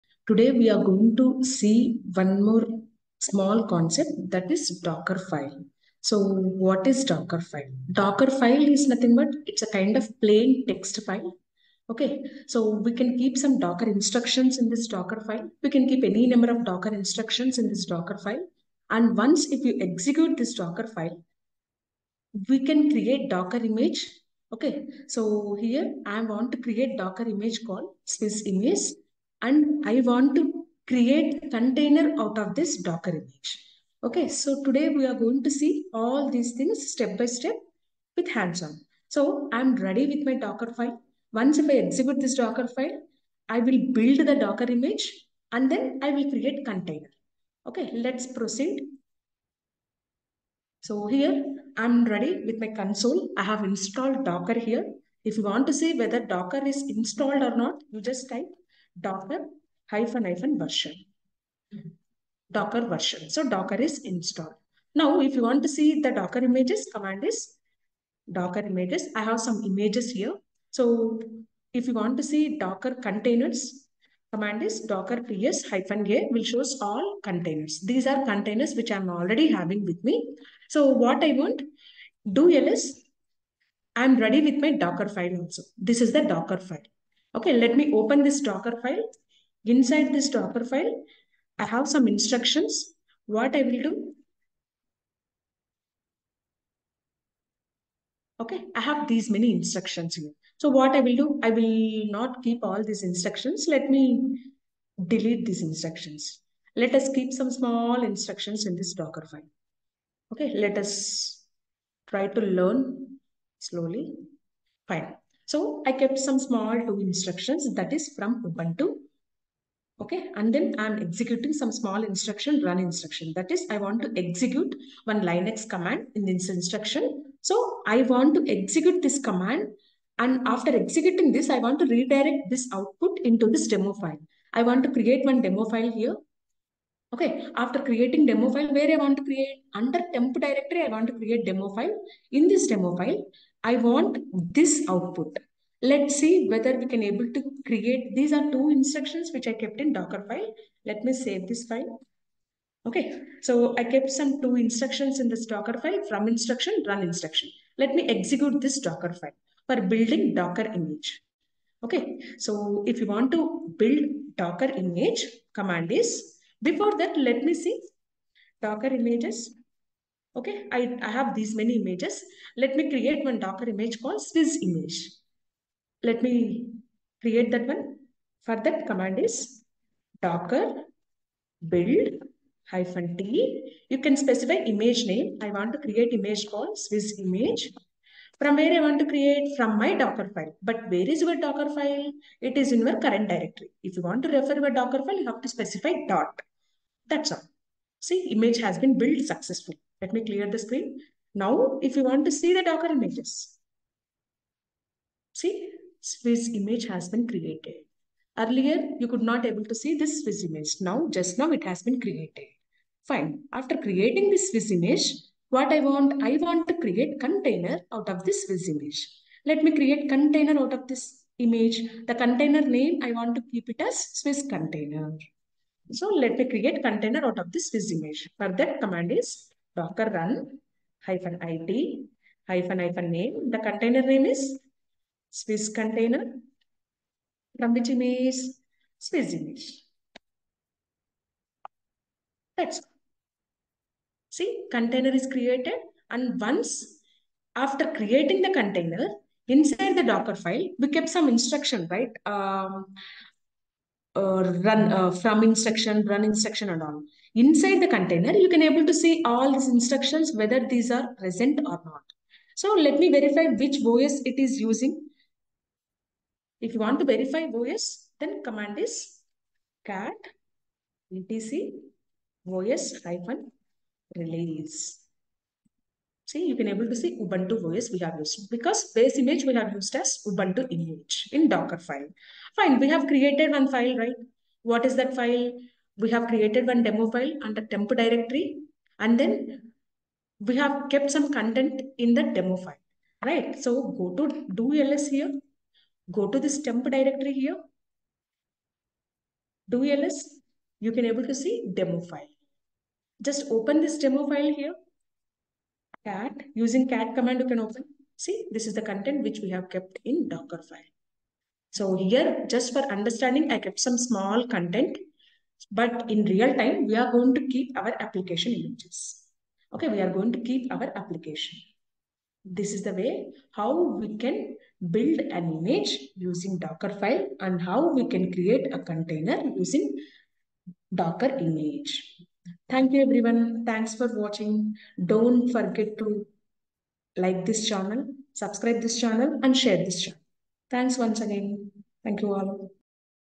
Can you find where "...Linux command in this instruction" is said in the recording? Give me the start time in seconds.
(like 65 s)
125 s.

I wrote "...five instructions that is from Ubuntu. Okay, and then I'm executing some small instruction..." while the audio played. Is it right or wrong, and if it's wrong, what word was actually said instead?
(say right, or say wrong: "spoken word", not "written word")
wrong: "two", not "five".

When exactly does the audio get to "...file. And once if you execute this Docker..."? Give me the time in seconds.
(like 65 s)
18 s.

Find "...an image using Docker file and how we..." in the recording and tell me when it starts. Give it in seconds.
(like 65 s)
325 s.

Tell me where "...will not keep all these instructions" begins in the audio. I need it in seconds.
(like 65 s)
101 s.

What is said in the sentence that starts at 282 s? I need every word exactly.
Fine, we have created one file, right?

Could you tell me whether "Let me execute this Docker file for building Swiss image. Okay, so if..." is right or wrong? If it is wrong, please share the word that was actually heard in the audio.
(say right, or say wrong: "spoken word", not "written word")
wrong: "Docker", not "Swiss".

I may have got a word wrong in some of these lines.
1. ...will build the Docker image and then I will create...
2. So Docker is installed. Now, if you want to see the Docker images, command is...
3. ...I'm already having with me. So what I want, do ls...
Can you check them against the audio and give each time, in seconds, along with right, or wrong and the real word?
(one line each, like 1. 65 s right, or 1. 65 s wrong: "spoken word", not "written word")
1. 43 s right
2. 63 s right
3. 78 s right.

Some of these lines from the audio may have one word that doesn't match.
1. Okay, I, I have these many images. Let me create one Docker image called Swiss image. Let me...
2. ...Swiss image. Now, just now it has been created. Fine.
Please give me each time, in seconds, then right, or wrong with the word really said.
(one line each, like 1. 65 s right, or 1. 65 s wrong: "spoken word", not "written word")
1. 170 s right
2. 210 s right.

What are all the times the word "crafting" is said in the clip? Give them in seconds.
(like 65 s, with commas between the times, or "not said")
not said.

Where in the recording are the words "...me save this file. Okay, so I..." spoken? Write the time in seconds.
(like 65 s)
151 s.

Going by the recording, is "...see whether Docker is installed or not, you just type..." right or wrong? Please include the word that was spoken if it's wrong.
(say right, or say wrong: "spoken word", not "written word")
right.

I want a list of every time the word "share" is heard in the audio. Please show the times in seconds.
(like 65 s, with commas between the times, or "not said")
339 s.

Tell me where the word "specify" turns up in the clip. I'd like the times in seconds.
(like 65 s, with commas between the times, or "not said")
184 s, 195 s.